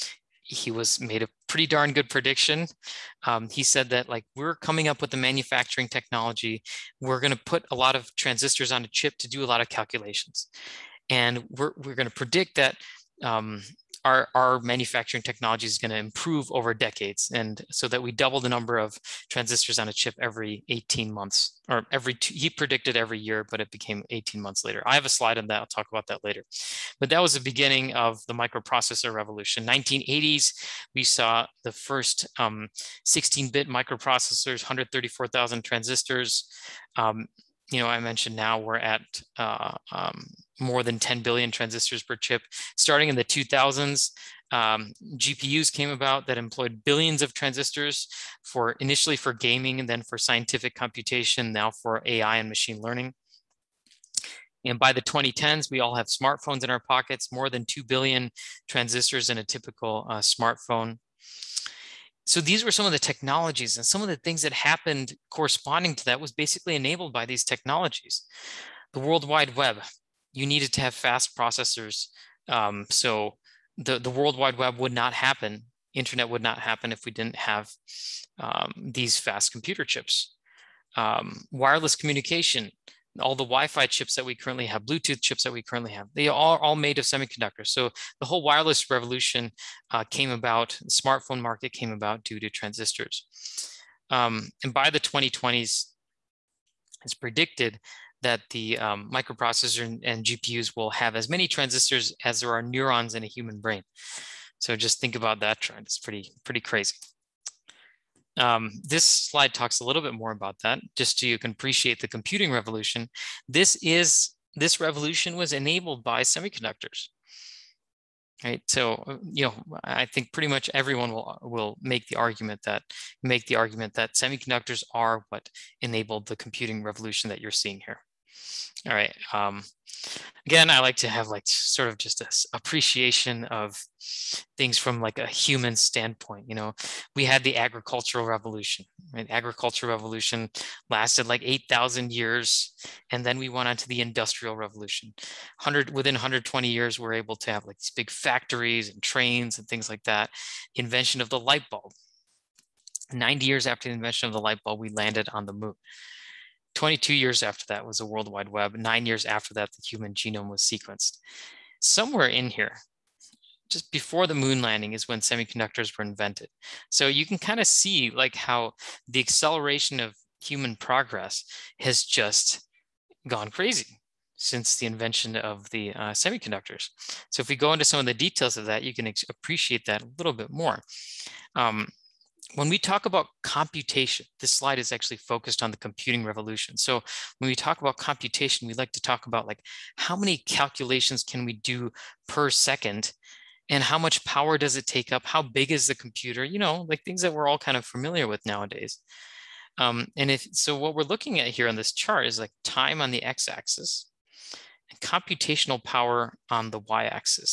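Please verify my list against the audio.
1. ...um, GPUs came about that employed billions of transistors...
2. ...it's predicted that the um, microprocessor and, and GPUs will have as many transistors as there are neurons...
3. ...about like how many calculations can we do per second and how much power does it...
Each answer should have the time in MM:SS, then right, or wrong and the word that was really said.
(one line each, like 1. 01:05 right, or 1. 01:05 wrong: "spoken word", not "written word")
1. 00:44 right
2. 01:37 right
3. 03:09 right.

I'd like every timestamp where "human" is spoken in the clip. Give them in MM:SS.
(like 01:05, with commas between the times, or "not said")
01:43, 02:15, 02:39, 02:50.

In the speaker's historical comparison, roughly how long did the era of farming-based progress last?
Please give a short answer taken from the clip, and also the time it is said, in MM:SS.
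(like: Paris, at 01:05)
8,000 years, at 02:21.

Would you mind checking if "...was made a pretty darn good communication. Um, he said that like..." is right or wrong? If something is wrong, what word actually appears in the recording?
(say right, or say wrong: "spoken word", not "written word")
wrong: "prediction", not "communication".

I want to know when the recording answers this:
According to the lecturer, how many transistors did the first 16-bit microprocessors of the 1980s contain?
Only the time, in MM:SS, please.
00:34.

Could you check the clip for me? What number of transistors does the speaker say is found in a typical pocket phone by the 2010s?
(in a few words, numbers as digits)
more than 2 billion.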